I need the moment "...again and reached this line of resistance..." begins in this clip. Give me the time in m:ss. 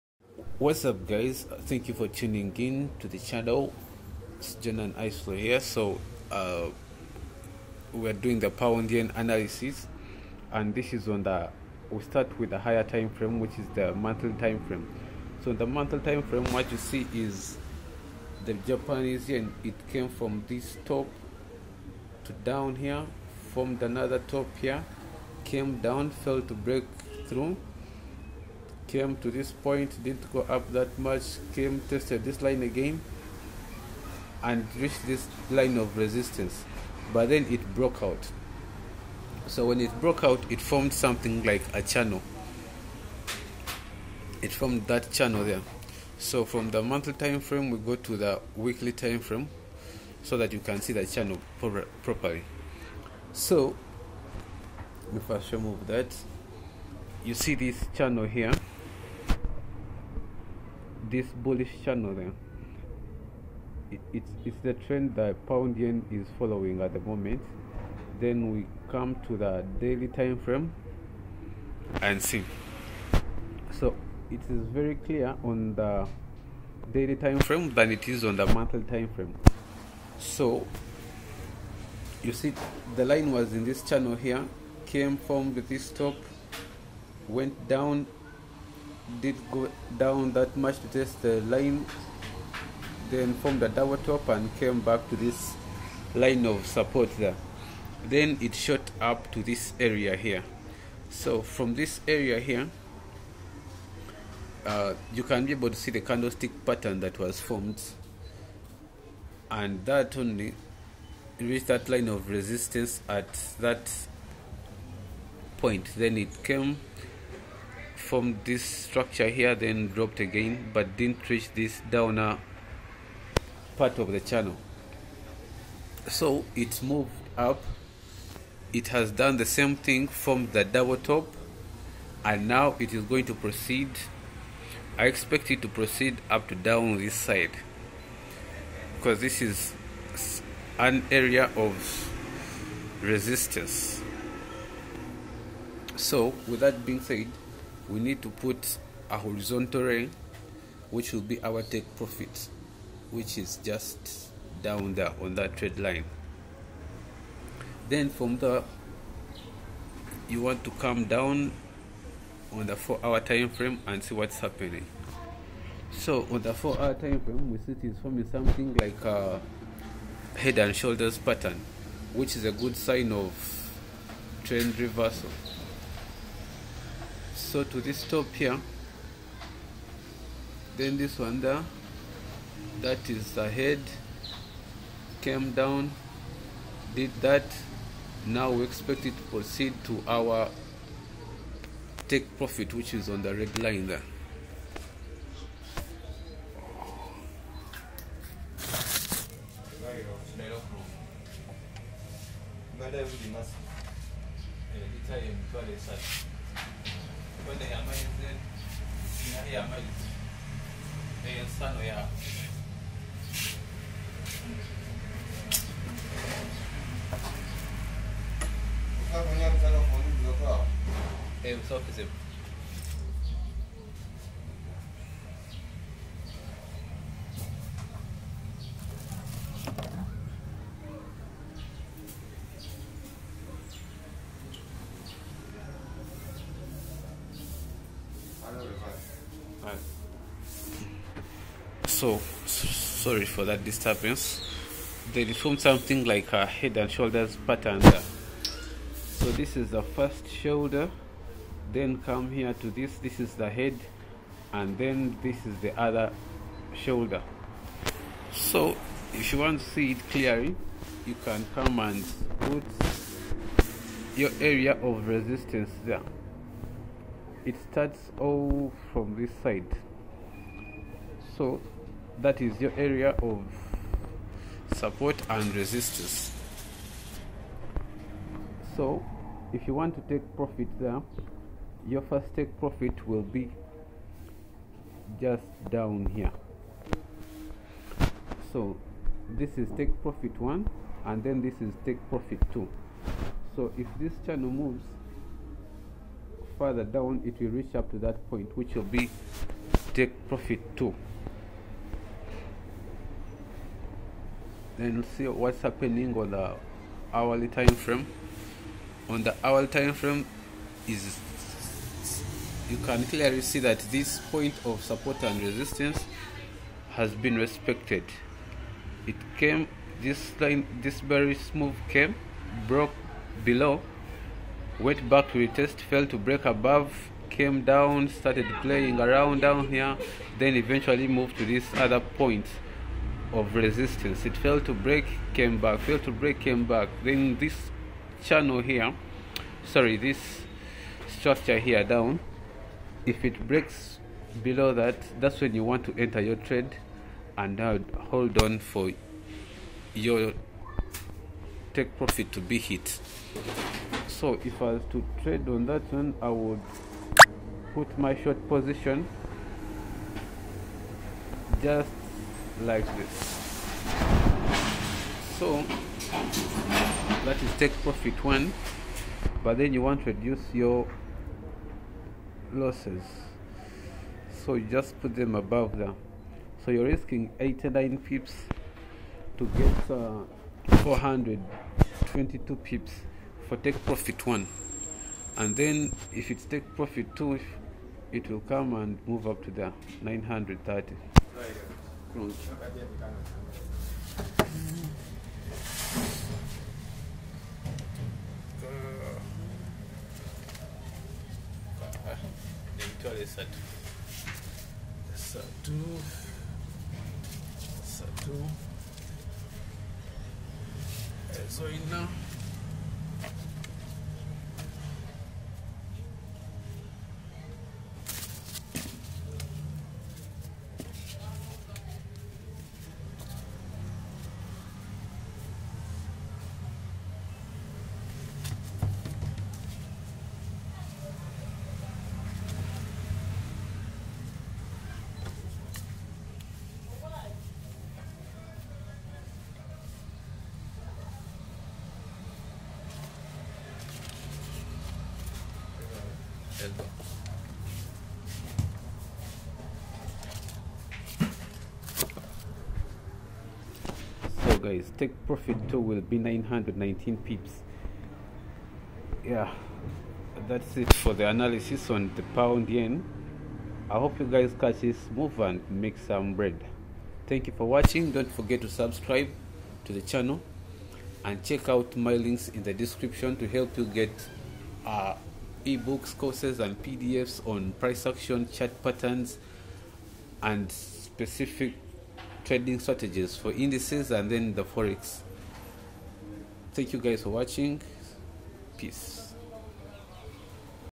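0:32.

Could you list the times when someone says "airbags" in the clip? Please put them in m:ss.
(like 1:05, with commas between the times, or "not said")
not said.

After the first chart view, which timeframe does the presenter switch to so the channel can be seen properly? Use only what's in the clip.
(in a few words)
Weekly.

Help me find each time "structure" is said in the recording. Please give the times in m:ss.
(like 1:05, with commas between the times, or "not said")
1:58, 5:41.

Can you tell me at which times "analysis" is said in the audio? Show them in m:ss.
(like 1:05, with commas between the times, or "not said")
0:09, 7:41.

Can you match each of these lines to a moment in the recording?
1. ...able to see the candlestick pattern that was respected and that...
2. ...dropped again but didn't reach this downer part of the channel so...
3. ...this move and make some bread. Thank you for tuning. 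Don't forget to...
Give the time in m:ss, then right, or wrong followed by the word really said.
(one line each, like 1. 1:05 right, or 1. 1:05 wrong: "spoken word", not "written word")
1. 1:45 wrong: "formed", not "respected"
2. 1:59 right
3. 7:44 wrong: "watching", not "tuning".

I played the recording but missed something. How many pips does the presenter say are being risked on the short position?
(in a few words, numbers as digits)
89.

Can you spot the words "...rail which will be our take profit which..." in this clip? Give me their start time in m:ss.
2:29.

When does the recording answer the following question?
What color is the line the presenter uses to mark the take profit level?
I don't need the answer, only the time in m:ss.
3:13.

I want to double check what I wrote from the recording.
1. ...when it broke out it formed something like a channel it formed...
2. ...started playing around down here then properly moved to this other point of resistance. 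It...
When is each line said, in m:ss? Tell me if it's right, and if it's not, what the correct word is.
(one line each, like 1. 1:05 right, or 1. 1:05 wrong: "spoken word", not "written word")
1. 0:39 right
2. 5:28 wrong: "eventually", not "properly".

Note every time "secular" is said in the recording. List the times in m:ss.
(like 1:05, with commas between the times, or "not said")
not said.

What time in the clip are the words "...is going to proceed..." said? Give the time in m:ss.
2:12.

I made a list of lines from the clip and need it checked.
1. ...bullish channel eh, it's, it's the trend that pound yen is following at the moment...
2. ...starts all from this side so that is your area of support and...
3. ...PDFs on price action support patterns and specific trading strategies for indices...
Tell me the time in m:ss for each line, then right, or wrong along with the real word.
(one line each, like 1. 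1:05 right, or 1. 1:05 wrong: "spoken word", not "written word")
1. 1:01 right
2. 4:27 right
3. 7:56 wrong: "chart", not "support".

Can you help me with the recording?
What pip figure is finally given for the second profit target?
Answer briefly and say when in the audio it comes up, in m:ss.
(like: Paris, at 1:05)
919, at 7:36.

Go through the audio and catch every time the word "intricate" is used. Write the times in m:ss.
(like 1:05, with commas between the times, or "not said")
not said.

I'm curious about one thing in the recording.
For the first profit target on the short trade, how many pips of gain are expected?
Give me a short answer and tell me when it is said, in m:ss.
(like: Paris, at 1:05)
422, at 6:20.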